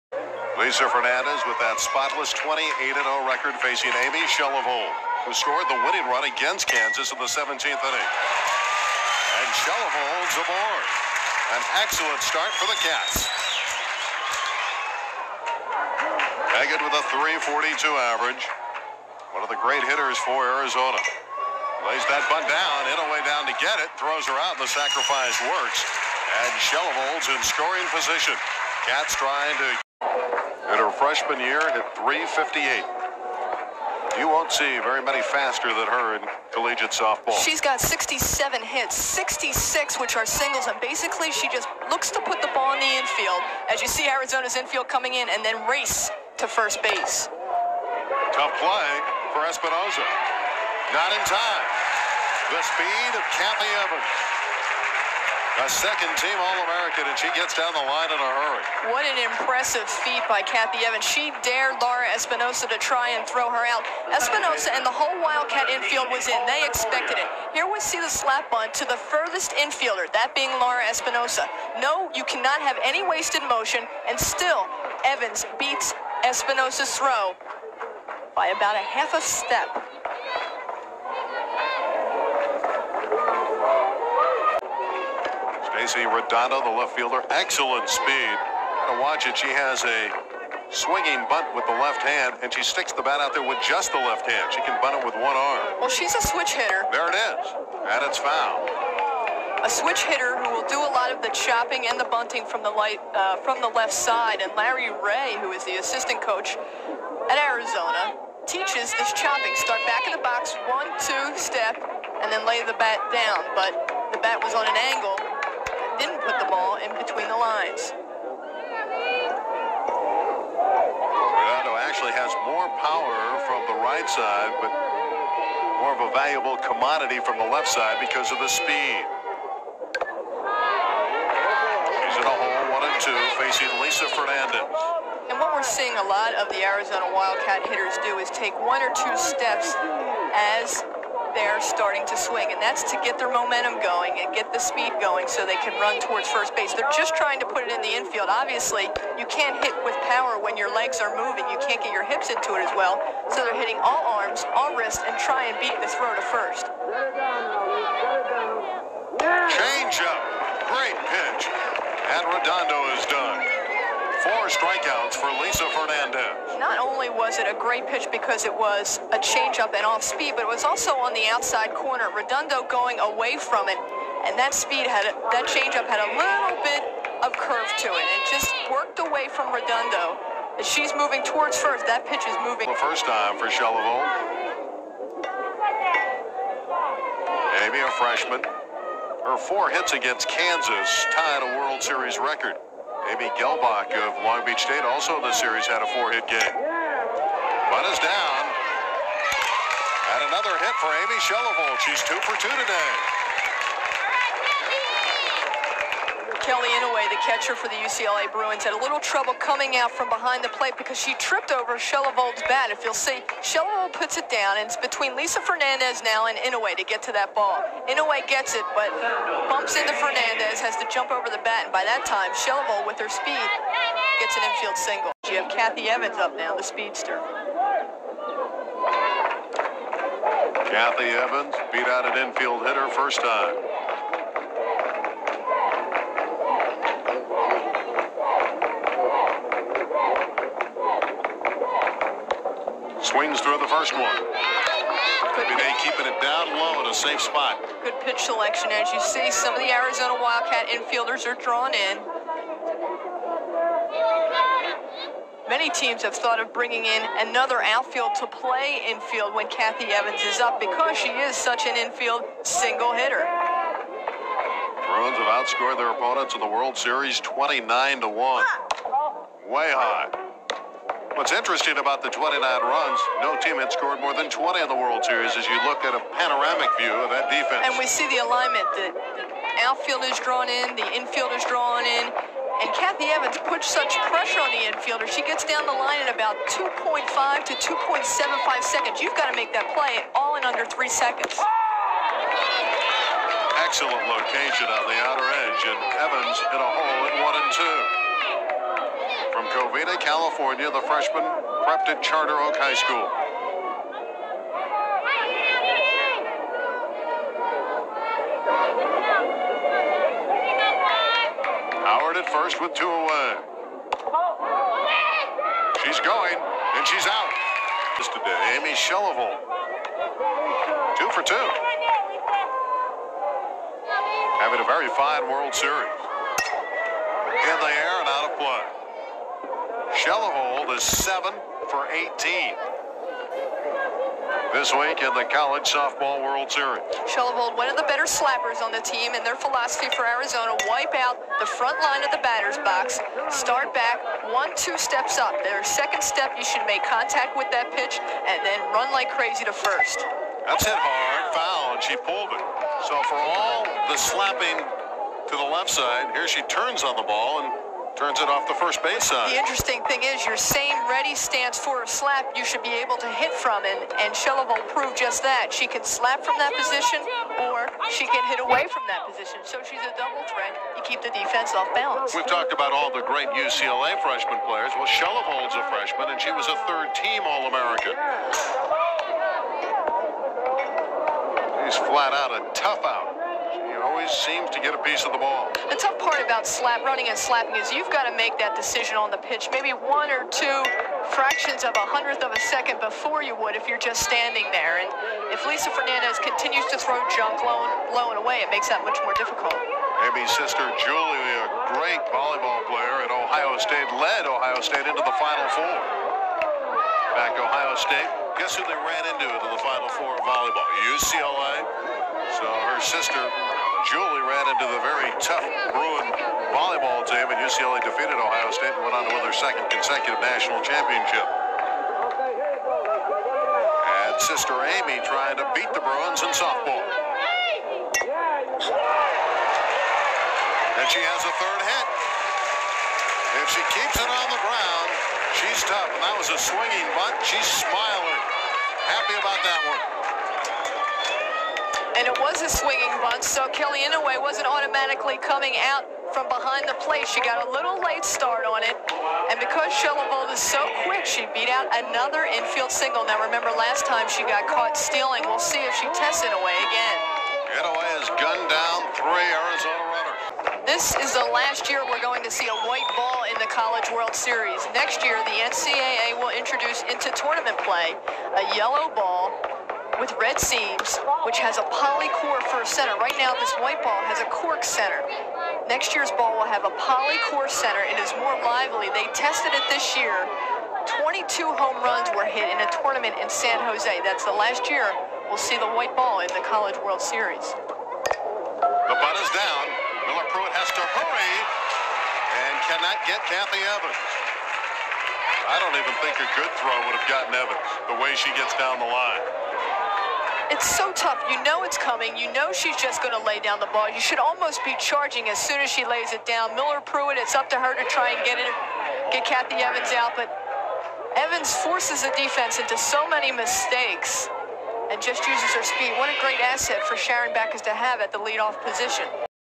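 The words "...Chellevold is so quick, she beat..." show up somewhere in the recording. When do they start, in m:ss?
7:29.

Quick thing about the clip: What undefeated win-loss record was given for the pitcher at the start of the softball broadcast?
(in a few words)
28-0.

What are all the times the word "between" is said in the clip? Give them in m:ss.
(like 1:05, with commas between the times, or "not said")
1:56, 3:34.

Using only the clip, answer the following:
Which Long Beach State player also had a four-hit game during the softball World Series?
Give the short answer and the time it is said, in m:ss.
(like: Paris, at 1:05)
Amy Gelbach, at 3:13.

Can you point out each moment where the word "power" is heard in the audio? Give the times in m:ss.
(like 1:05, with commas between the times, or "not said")
2:02, 2:30.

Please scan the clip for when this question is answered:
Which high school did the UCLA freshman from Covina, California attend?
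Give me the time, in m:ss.
5:02.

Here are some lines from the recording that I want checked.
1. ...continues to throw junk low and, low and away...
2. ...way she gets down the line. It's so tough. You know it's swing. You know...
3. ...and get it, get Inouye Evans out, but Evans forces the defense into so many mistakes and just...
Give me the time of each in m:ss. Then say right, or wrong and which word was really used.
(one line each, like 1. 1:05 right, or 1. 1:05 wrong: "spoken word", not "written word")
1. 6:36 right
2. 8:18 wrong: "coming", not "swing"
3. 8:28 wrong: "Kathy", not "Inouye".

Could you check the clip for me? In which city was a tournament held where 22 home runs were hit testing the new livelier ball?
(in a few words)
San Jose.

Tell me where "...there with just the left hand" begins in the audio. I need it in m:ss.
1:33.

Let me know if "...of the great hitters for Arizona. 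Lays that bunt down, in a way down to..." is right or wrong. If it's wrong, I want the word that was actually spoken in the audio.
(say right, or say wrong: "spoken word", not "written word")
right.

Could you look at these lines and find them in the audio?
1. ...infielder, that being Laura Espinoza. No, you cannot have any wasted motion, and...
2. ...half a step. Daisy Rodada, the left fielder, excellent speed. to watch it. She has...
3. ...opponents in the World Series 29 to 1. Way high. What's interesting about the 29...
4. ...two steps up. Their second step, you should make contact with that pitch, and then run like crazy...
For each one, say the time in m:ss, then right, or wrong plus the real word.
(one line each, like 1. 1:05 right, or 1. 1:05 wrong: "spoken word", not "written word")
1. 1:09 right
2. 1:18 right
3. 4:25 right
4. 5:44 right.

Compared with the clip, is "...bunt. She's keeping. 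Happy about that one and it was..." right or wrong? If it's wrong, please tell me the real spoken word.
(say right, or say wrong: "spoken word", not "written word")
wrong: "smiling", not "keeping".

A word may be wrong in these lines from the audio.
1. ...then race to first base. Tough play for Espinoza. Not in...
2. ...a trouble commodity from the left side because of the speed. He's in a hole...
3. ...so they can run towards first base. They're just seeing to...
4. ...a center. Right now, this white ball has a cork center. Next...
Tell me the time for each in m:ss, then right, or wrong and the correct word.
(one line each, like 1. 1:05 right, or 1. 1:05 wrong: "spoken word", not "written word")
1. 0:45 right
2. 2:06 wrong: "valuable", not "trouble"
3. 2:25 wrong: "trying", not "seeing"
4. 7:52 right.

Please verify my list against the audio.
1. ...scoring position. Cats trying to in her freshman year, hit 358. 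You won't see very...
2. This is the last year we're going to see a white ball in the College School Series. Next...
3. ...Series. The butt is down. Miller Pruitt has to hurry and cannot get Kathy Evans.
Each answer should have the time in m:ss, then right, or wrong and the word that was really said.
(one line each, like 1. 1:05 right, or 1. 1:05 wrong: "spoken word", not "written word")
1. 0:27 right
2. 7:40 wrong: "World", not "School"
3. 8:06 right.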